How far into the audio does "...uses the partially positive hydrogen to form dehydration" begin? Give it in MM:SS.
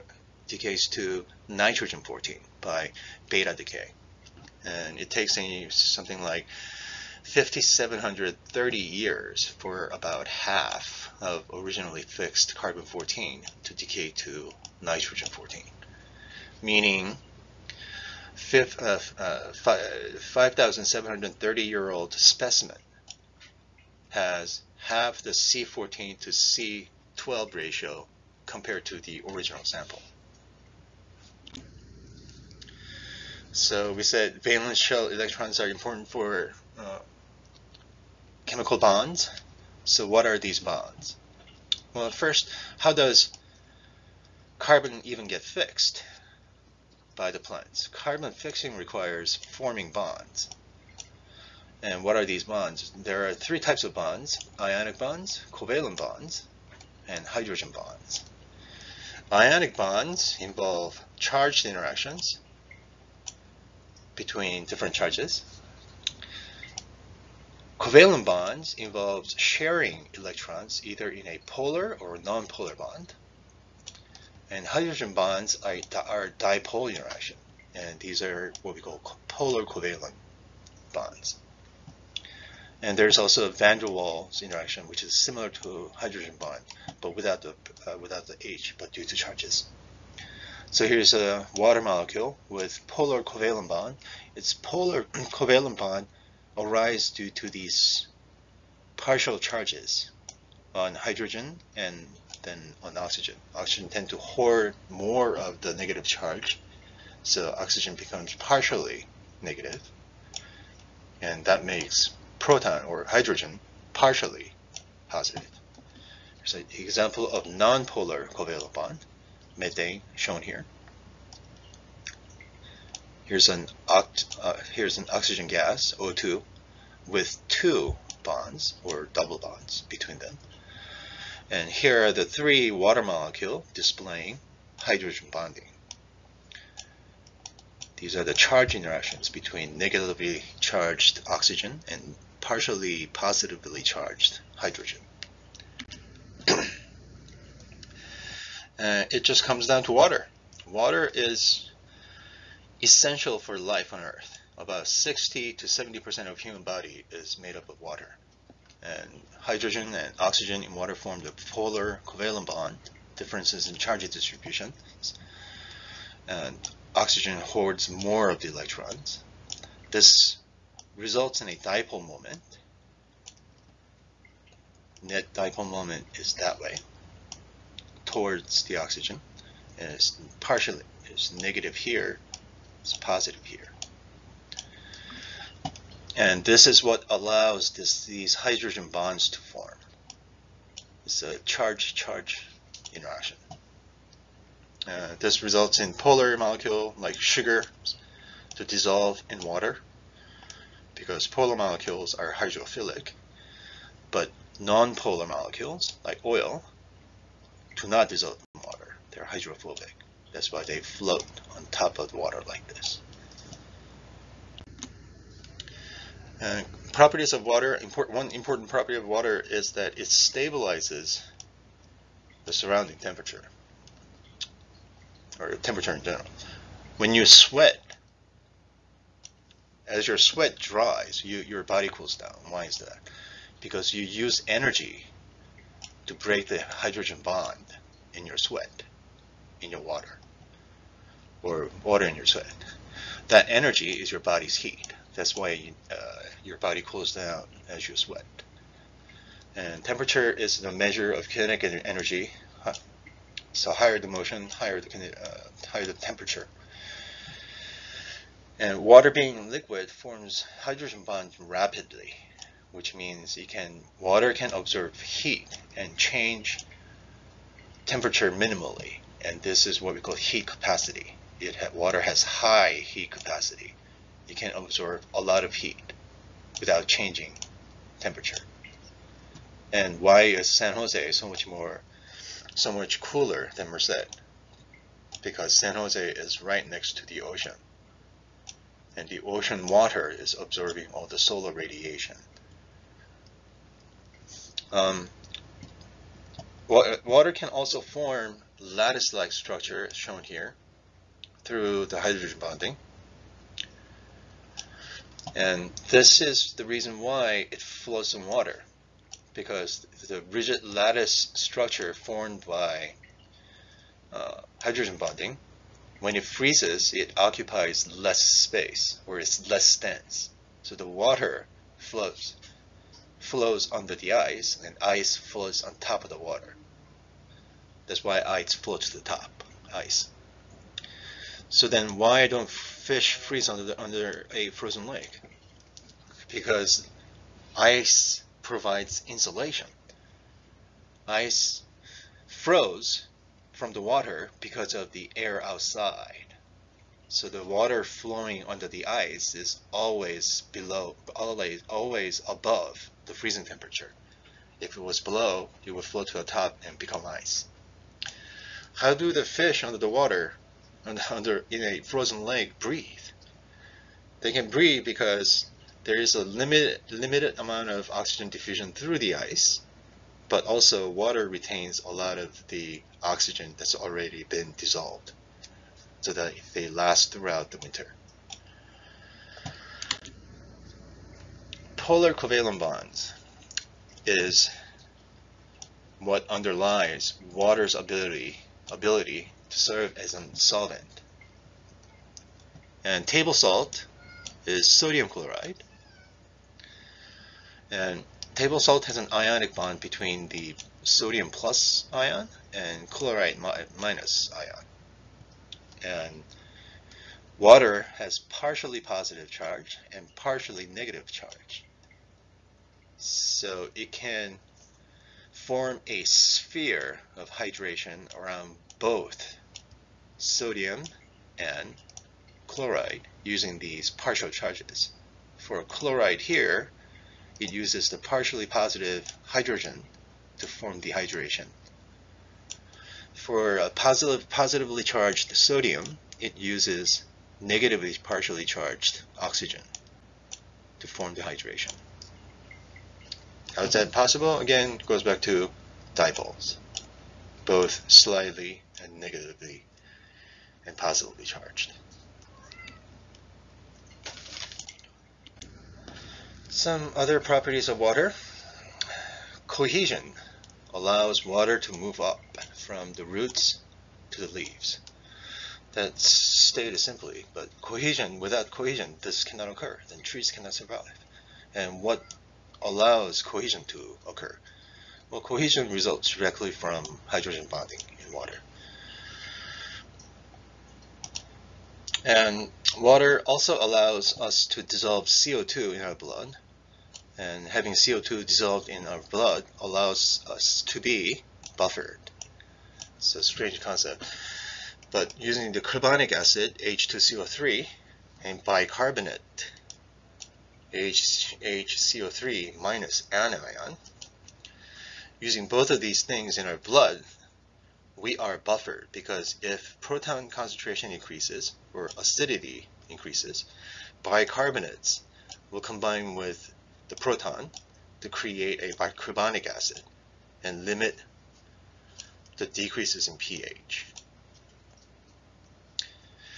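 07:07.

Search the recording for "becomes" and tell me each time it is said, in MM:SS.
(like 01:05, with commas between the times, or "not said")
01:47, 05:56.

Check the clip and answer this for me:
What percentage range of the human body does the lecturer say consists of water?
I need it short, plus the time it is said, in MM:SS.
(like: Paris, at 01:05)
60 to 70%, at 02:34.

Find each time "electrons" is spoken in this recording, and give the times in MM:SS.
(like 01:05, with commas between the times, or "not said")
00:35, 01:10, 02:48.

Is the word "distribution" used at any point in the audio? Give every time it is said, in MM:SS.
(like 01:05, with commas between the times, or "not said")
02:44.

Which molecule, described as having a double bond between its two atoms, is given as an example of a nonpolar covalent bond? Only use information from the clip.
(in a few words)
oxygen gas (O2).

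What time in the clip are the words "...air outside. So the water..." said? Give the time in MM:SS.
05:45.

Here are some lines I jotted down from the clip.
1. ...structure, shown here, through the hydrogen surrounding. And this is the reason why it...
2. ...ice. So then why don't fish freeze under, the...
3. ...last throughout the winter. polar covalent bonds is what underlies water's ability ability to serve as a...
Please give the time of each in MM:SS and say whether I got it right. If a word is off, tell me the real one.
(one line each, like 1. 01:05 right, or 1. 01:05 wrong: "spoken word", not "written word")
1. 04:59 wrong: "bonding", not "surrounding"
2. 05:29 right
3. 06:16 right.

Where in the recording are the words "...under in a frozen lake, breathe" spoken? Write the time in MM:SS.
06:00.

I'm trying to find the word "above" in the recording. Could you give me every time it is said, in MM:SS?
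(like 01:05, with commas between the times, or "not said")
05:52.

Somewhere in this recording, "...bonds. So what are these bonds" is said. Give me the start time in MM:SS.
00:38.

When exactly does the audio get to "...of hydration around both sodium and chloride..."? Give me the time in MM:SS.
06:57.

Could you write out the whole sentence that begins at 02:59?
And it's partially it's negative here, it's positive here.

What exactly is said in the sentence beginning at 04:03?
That energy is your body's heat.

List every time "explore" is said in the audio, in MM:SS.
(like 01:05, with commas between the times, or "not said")
not said.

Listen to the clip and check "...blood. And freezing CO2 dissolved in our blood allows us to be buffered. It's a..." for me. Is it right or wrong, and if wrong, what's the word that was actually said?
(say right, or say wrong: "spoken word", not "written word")
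wrong: "having", not "freezing".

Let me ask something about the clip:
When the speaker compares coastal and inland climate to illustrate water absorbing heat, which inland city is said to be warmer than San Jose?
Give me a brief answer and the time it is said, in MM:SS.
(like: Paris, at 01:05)
Merced, at 04:43.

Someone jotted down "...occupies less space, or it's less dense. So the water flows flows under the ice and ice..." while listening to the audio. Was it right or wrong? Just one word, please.
right.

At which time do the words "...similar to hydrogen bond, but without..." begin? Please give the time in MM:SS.
01:25.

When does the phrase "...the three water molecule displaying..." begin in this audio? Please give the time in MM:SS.
02:12.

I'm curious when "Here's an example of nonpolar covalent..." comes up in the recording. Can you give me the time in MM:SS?
01:56.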